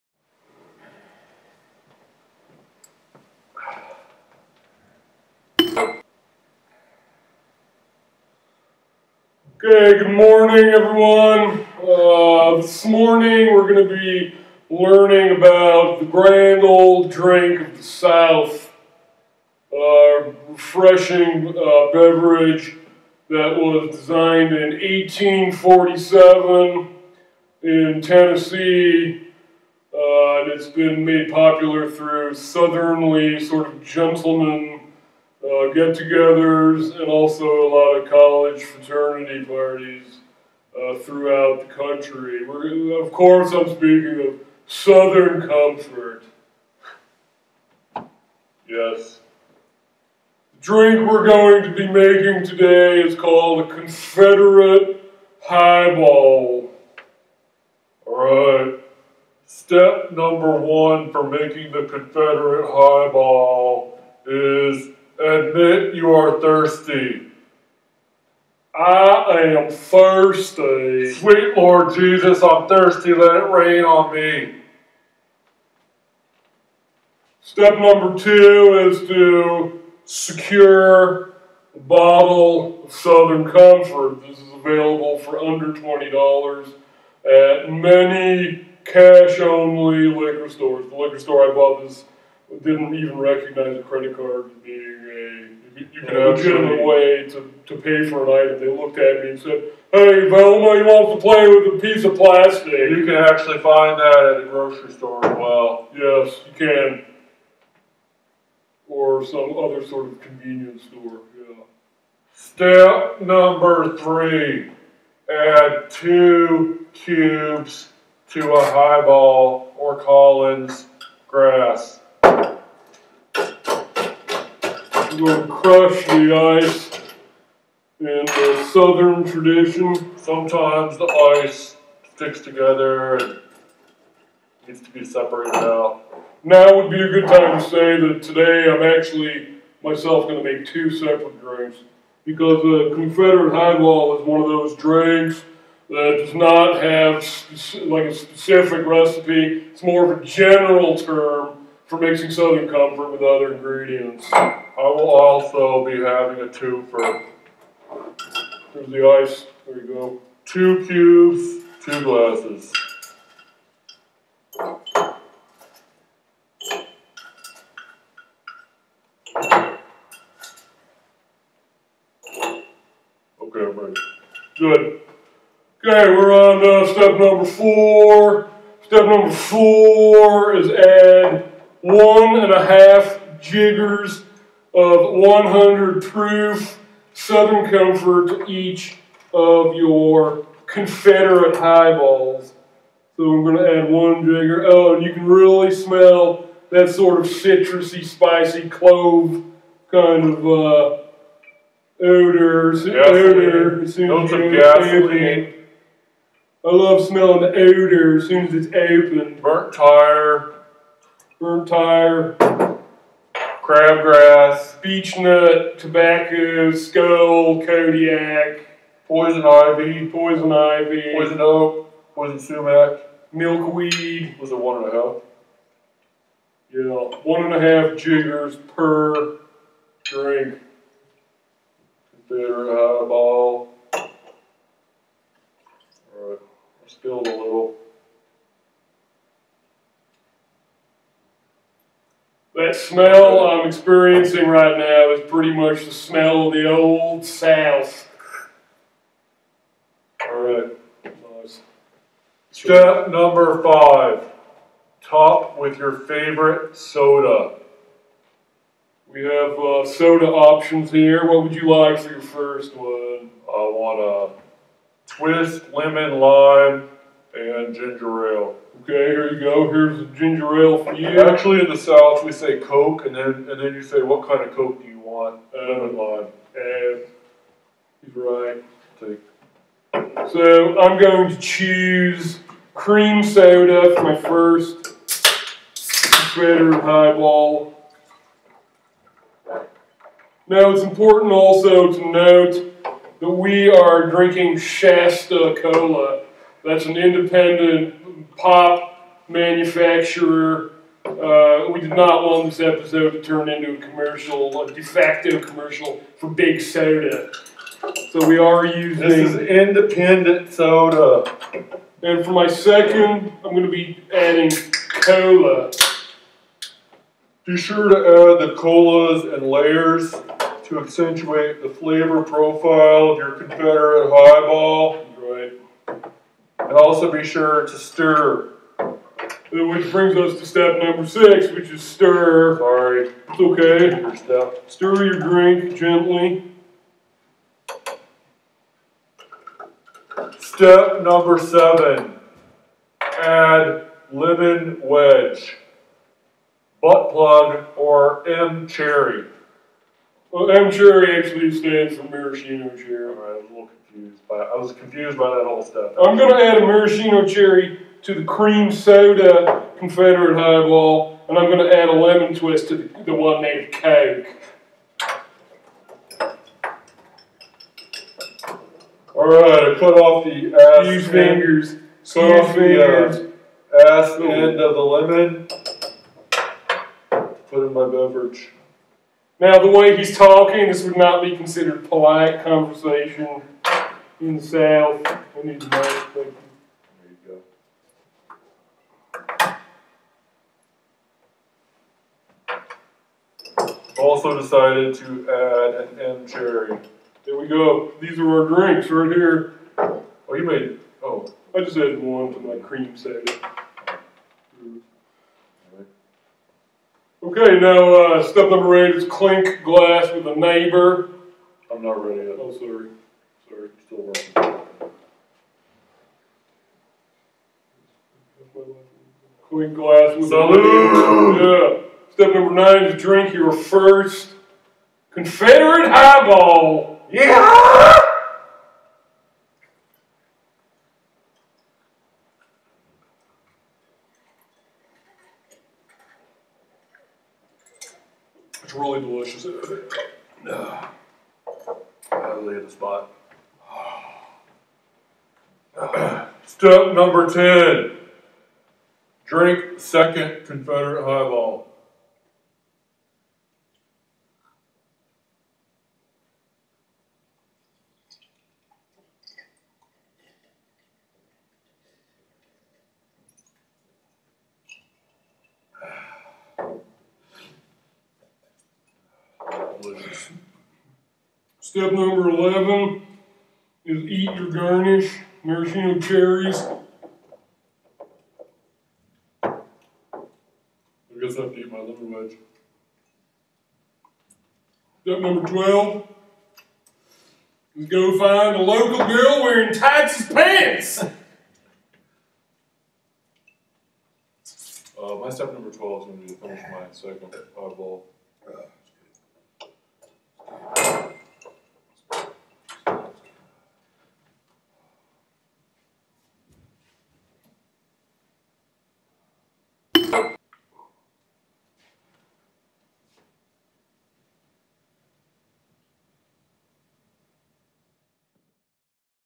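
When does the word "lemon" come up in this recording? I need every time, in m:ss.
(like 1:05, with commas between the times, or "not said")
4:25, 4:35, 5:44, 6:01, 6:14, 8:01.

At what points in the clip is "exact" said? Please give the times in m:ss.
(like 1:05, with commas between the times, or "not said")
not said.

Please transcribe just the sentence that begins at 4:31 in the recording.
Actually, in the South, we say Coke, and then and then you say, what kind of Coke do you want?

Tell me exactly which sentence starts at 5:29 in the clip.
Which brings us to step number six, which is stir.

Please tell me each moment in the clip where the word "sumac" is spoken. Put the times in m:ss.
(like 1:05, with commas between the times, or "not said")
3:42.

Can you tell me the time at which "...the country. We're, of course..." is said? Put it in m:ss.
0:41.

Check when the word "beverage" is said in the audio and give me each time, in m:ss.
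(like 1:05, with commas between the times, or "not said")
0:21, 6:17.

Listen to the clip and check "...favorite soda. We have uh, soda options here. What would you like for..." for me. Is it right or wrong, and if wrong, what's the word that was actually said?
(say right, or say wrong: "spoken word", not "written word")
right.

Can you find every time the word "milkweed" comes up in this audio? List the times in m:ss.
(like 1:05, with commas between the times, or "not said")
3:43.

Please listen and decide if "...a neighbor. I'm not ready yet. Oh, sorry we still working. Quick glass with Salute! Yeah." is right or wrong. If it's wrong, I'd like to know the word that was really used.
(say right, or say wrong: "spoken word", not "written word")
right.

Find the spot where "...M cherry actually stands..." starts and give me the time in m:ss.
5:50.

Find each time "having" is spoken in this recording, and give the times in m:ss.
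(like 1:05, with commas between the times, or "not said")
2:36.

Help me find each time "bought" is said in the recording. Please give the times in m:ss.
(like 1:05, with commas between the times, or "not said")
1:31.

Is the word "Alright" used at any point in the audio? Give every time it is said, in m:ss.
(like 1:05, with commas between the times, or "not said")
0:58, 3:56.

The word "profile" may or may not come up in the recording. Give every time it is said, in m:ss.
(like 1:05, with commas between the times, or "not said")
5:22.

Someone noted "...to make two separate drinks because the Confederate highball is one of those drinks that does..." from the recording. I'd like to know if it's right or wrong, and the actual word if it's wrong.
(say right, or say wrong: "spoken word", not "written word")
right.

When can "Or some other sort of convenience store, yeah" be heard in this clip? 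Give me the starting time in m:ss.
1:48.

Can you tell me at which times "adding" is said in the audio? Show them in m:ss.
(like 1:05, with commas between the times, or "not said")
5:14.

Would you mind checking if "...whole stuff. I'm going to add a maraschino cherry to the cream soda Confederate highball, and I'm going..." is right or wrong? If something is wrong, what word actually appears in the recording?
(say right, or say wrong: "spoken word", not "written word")
right.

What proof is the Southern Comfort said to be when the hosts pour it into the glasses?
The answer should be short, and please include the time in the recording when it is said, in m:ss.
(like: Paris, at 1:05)
100, at 3:05.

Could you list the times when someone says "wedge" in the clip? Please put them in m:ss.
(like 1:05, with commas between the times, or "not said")
5:44, 8:02.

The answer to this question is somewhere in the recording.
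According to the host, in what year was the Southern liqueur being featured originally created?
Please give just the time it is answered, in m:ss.
0:24.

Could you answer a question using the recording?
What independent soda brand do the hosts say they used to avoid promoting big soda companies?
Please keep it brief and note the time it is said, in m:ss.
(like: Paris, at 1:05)
Shasta Cola, at 4:54.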